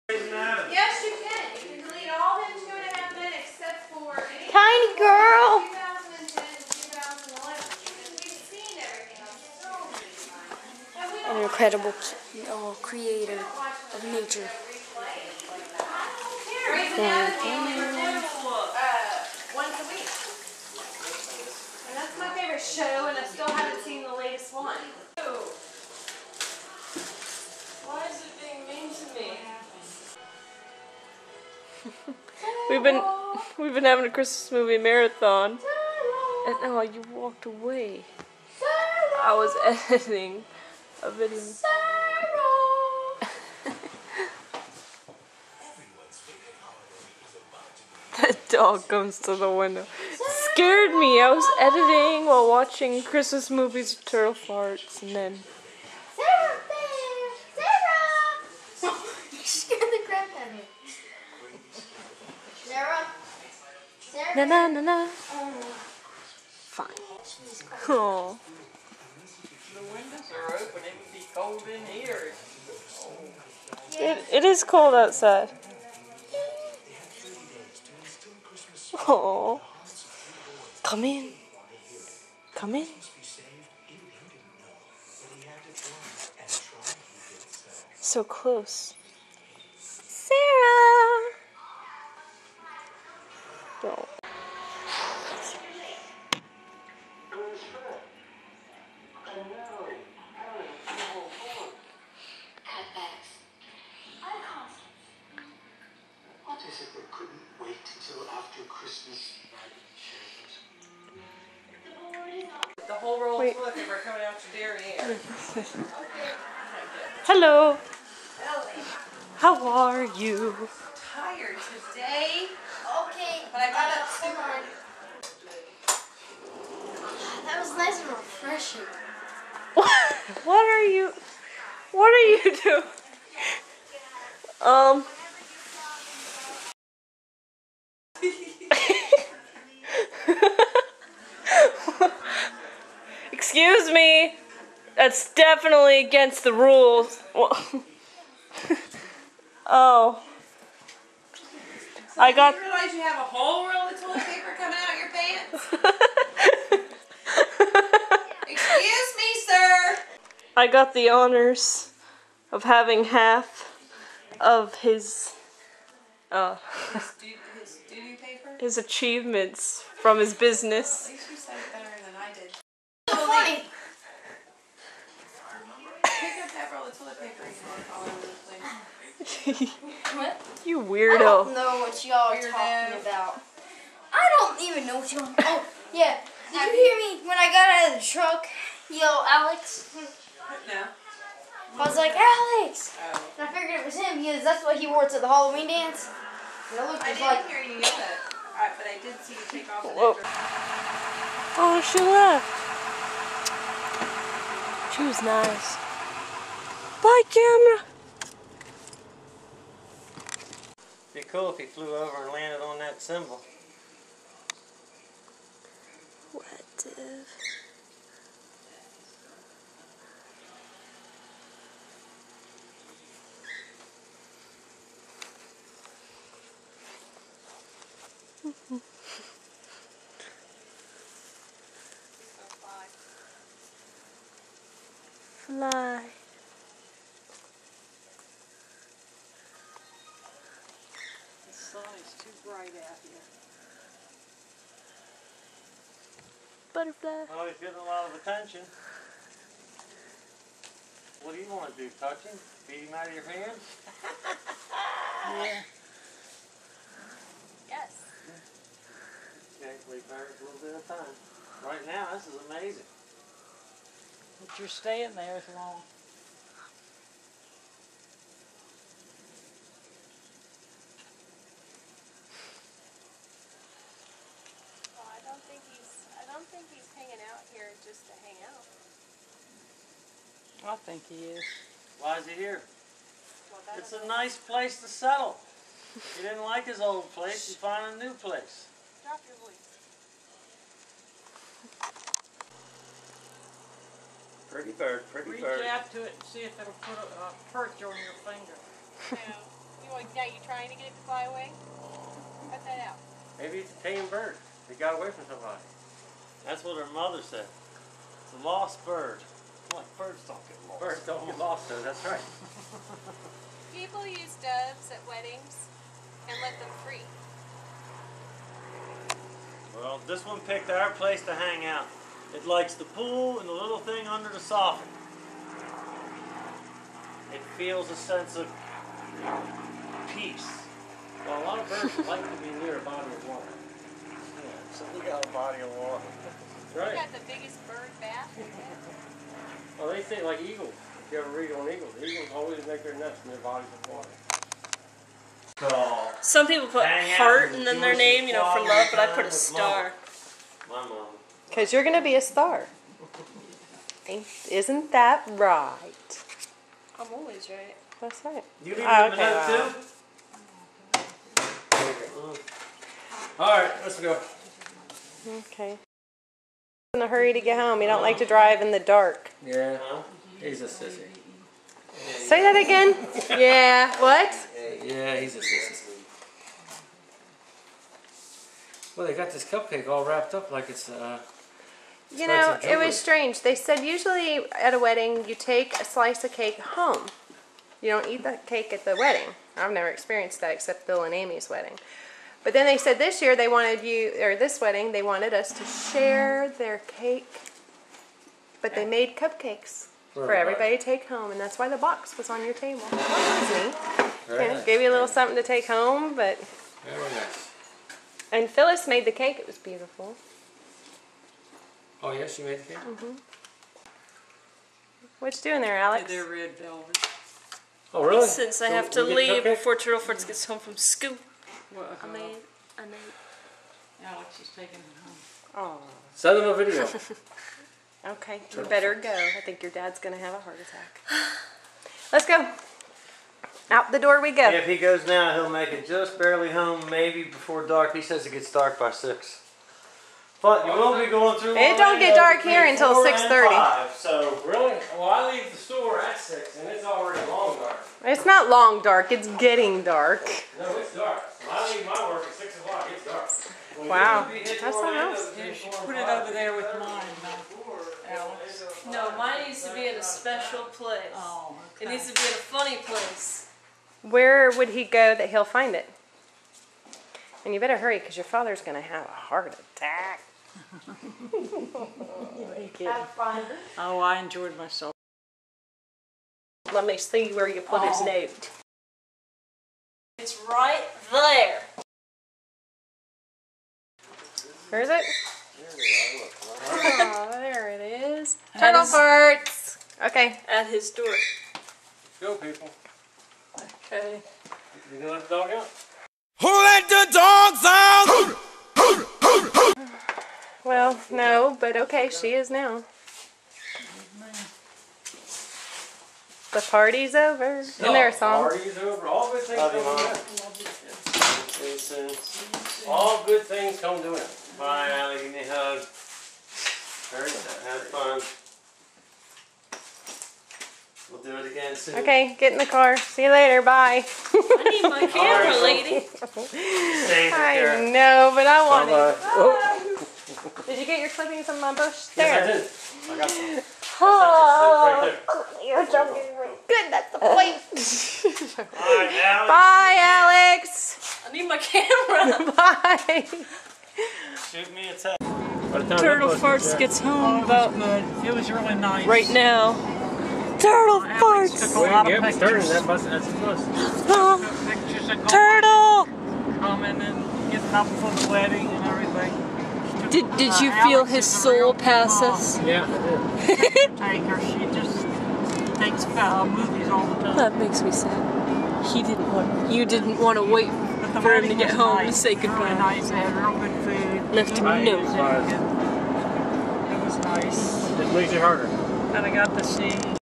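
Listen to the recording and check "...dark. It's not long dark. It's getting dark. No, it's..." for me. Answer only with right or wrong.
right.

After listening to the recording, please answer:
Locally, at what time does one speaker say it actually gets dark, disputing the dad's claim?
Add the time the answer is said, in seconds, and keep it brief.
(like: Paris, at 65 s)
6:30, at 442 s.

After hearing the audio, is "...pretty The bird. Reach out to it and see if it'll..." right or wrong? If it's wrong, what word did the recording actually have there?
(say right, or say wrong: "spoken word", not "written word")
wrong: "Reach", not "The".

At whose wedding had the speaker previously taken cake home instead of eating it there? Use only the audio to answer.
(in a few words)
Bill and Amy's.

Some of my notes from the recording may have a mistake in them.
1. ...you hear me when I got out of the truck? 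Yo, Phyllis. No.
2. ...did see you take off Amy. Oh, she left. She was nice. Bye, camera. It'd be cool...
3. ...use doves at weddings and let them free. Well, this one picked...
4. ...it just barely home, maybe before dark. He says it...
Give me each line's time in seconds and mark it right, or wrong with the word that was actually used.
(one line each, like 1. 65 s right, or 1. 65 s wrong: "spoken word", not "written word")
1. 186 s wrong: "Alex", not "Phyllis"
2. 199 s wrong: "Whoa", not "Amy"
3. 314 s right
4. 435 s right.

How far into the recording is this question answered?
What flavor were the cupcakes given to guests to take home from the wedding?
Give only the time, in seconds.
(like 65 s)
416 s.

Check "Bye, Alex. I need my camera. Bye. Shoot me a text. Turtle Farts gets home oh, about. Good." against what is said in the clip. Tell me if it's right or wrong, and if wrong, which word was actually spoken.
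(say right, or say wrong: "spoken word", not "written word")
right.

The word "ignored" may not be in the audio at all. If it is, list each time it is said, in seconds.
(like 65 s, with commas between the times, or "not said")
not said.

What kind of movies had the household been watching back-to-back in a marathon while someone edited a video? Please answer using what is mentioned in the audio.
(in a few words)
Christmas movies.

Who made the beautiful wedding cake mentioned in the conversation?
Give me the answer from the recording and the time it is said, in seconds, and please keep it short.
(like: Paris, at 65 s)
Phyllis, at 408 s.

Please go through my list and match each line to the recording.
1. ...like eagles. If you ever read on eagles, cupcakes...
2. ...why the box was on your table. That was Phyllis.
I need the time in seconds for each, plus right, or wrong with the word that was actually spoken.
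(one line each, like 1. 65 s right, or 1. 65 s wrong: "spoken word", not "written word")
1. 340 s wrong: "eagles", not "cupcakes"
2. 401 s wrong: "Nice", not "Phyllis".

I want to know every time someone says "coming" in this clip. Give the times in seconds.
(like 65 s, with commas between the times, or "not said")
114 s, 154 s, 556 s.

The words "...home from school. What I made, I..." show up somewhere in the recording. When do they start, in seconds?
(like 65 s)
420 s.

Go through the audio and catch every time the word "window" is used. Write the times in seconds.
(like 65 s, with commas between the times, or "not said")
49 s, 69 s.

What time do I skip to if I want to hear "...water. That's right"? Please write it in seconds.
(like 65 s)
335 s.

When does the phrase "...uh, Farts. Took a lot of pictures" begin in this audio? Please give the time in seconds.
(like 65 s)
550 s.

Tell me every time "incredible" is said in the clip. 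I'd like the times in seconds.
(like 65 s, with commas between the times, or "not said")
11 s.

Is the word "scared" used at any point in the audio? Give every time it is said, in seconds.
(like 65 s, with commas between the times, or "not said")
50 s, 59 s.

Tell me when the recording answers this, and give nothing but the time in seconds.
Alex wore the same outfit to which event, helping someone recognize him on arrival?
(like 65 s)
195 s.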